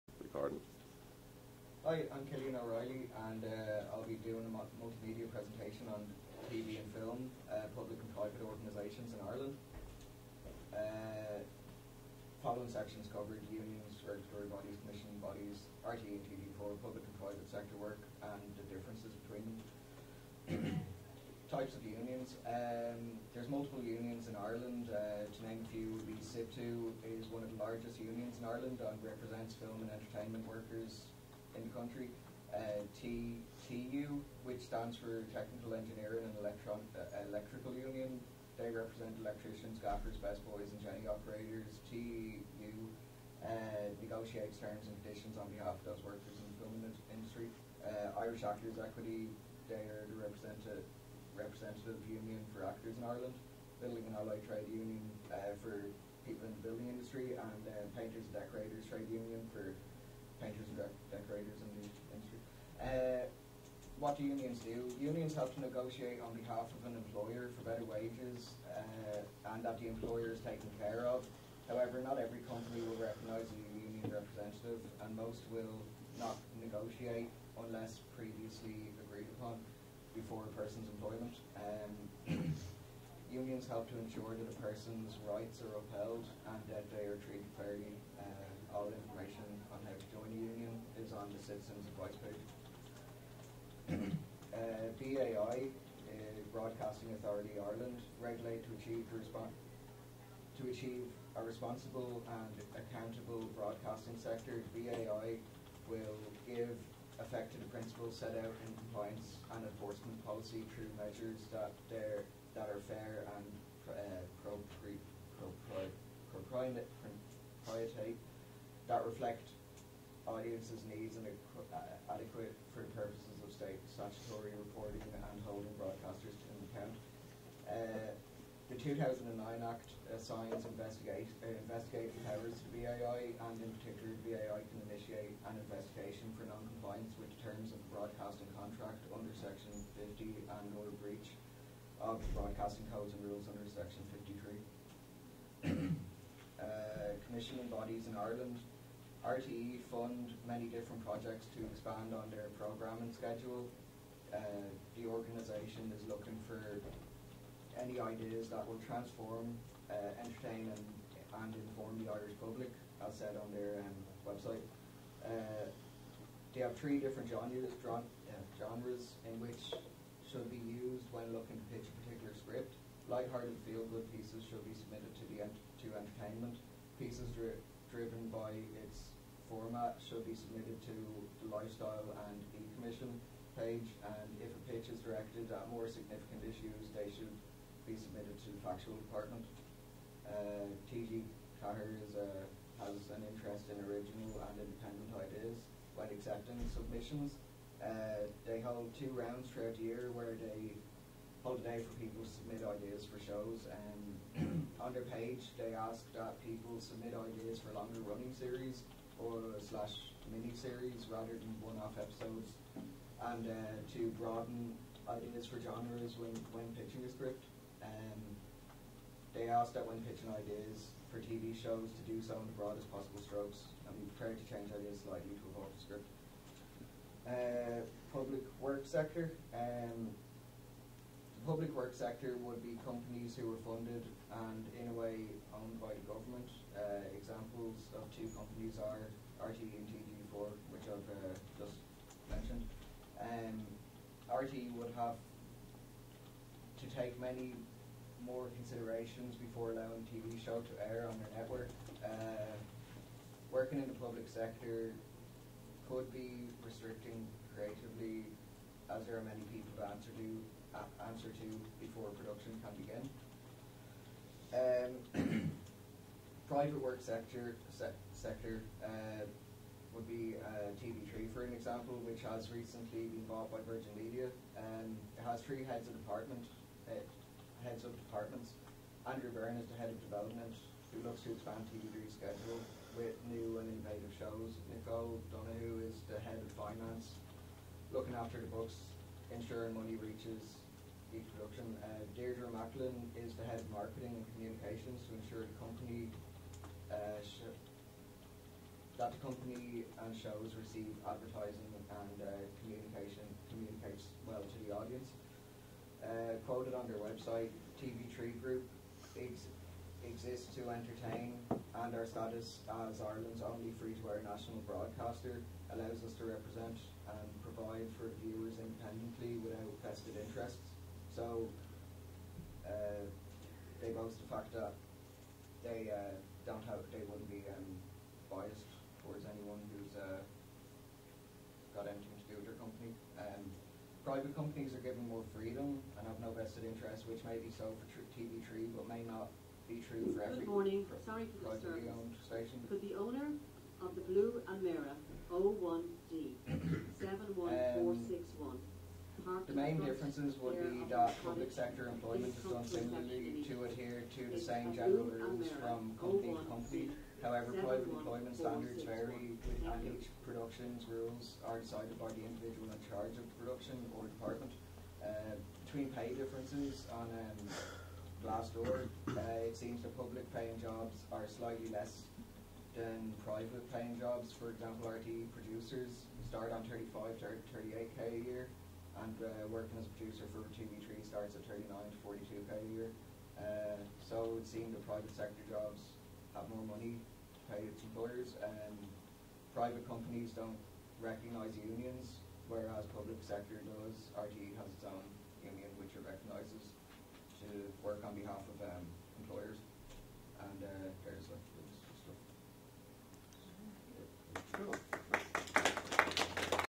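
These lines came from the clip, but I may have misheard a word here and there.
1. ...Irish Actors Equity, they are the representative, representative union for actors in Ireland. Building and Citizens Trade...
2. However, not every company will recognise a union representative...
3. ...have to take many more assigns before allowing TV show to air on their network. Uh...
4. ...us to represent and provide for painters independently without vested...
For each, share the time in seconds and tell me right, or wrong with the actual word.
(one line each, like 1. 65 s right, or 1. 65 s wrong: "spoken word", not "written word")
1. 48 s wrong: "Allied", not "Citizens"
2. 71 s right
3. 244 s wrong: "considerations", not "assigns"
4. 316 s wrong: "viewers", not "painters".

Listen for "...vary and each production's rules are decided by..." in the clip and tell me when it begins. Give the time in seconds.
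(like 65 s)
358 s.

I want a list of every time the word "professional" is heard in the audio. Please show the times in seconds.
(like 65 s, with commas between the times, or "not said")
not said.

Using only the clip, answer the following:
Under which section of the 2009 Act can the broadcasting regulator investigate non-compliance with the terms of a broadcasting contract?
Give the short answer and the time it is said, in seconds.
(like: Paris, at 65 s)
Section 50, at 139 s.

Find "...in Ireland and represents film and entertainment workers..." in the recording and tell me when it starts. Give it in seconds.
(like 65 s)
28 s.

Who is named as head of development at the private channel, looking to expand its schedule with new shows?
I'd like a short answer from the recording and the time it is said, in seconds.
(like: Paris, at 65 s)
Andrew Byrne, at 279 s.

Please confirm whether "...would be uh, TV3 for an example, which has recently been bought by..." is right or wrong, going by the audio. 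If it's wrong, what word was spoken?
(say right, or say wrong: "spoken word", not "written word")
right.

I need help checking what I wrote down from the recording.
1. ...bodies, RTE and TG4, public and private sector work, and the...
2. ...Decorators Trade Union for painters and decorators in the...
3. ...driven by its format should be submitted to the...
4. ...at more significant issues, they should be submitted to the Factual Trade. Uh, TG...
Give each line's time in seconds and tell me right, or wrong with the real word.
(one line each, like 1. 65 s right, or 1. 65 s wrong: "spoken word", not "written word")
1. 15 s right
2. 58 s right
3. 177 s right
4. 185 s wrong: "Department", not "Trade".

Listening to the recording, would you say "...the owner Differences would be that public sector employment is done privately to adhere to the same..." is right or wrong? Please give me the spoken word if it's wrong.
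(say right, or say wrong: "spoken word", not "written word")
wrong: "similarly", not "privately".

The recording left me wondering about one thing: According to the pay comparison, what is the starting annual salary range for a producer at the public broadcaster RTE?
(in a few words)
35 to 38k.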